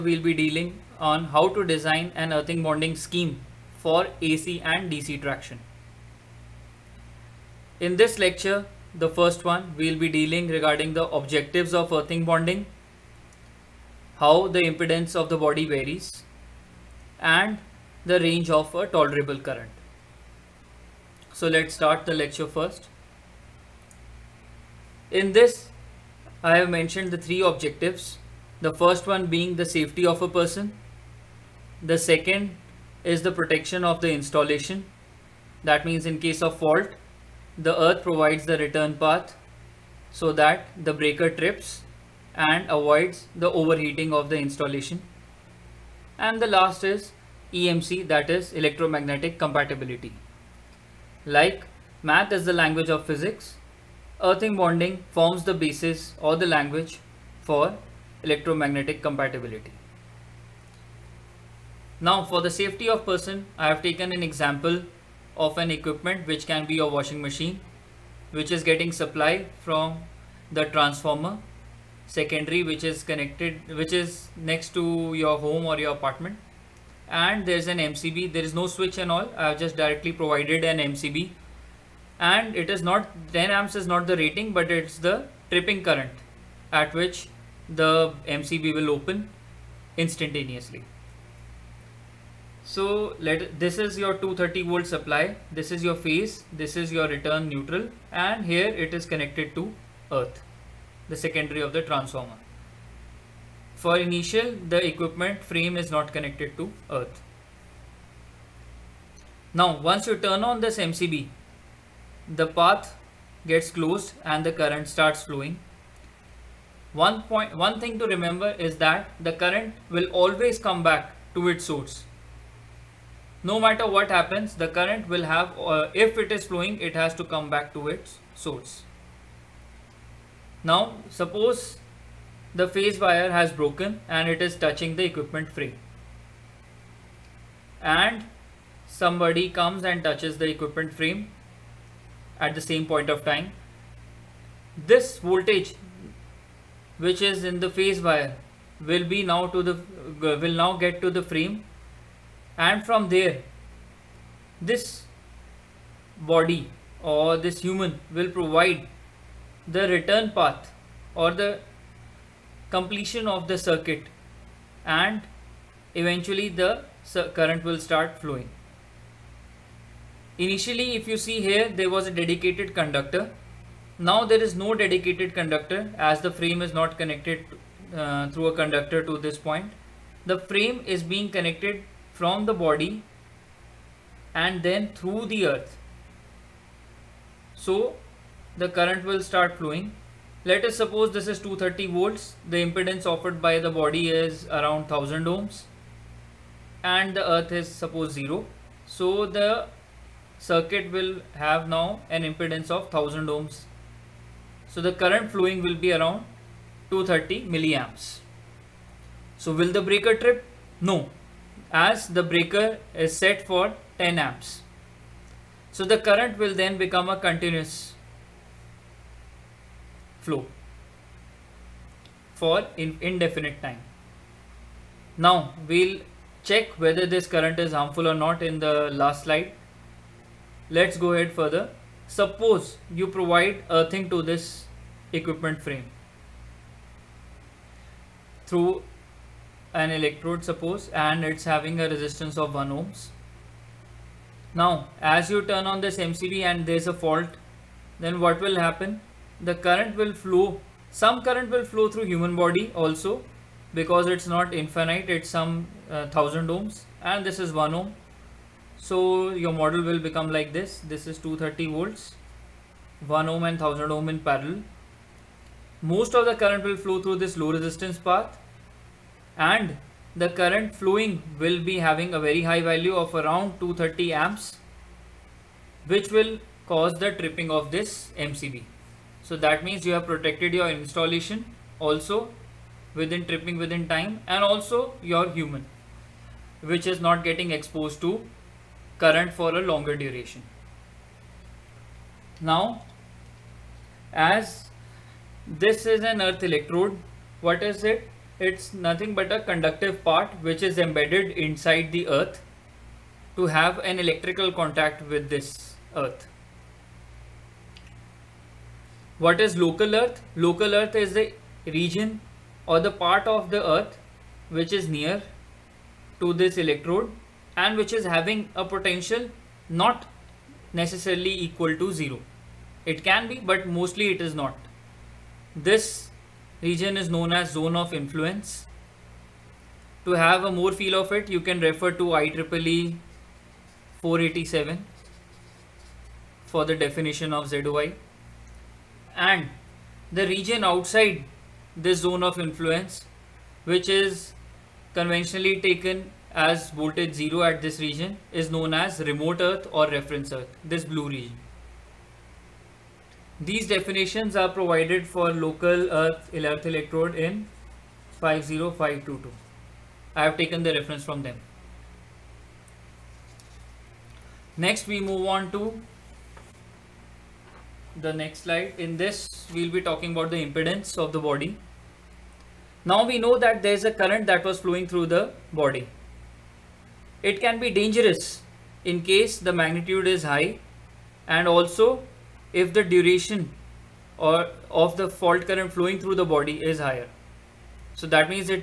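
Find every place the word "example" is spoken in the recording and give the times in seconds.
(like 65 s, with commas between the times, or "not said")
64 s.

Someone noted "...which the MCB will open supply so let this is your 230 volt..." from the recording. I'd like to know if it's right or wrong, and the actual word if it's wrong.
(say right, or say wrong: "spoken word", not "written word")
wrong: "instantaneously", not "supply".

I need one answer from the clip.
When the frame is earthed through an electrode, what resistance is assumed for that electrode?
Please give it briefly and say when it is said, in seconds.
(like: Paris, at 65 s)
1 ohm, at 242 s.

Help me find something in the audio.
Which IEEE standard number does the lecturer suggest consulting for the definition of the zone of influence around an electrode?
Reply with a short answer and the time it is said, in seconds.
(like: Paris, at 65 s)
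IEEE 487, at 332 s.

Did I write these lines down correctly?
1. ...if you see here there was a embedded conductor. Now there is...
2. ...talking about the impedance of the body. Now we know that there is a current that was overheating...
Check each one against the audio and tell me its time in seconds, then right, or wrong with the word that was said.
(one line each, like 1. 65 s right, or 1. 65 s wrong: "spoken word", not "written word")
1. 170 s wrong: "dedicated", not "embedded"
2. 369 s wrong: "flowing", not "overheating".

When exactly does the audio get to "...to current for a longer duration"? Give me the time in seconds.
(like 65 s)
288 s.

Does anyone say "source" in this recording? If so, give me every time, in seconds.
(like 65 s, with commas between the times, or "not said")
121 s, 128 s.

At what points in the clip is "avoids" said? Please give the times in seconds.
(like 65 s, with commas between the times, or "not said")
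42 s.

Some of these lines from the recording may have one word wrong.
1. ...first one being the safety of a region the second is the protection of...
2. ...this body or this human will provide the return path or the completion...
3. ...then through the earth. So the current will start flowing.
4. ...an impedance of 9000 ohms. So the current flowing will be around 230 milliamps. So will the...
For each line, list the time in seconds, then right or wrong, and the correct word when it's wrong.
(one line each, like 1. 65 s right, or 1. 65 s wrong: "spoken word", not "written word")
1. 28 s wrong: "person", not "region"
2. 154 s right
3. 184 s right
4. 202 s wrong: "1000", not "9000".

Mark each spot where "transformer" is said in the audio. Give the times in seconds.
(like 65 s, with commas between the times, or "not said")
70 s, 101 s.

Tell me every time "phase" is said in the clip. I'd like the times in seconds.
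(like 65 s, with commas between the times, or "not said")
96 s, 132 s, 147 s.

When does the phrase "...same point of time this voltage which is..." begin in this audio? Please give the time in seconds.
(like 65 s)
142 s.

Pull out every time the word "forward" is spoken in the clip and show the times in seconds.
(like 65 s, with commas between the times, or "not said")
not said.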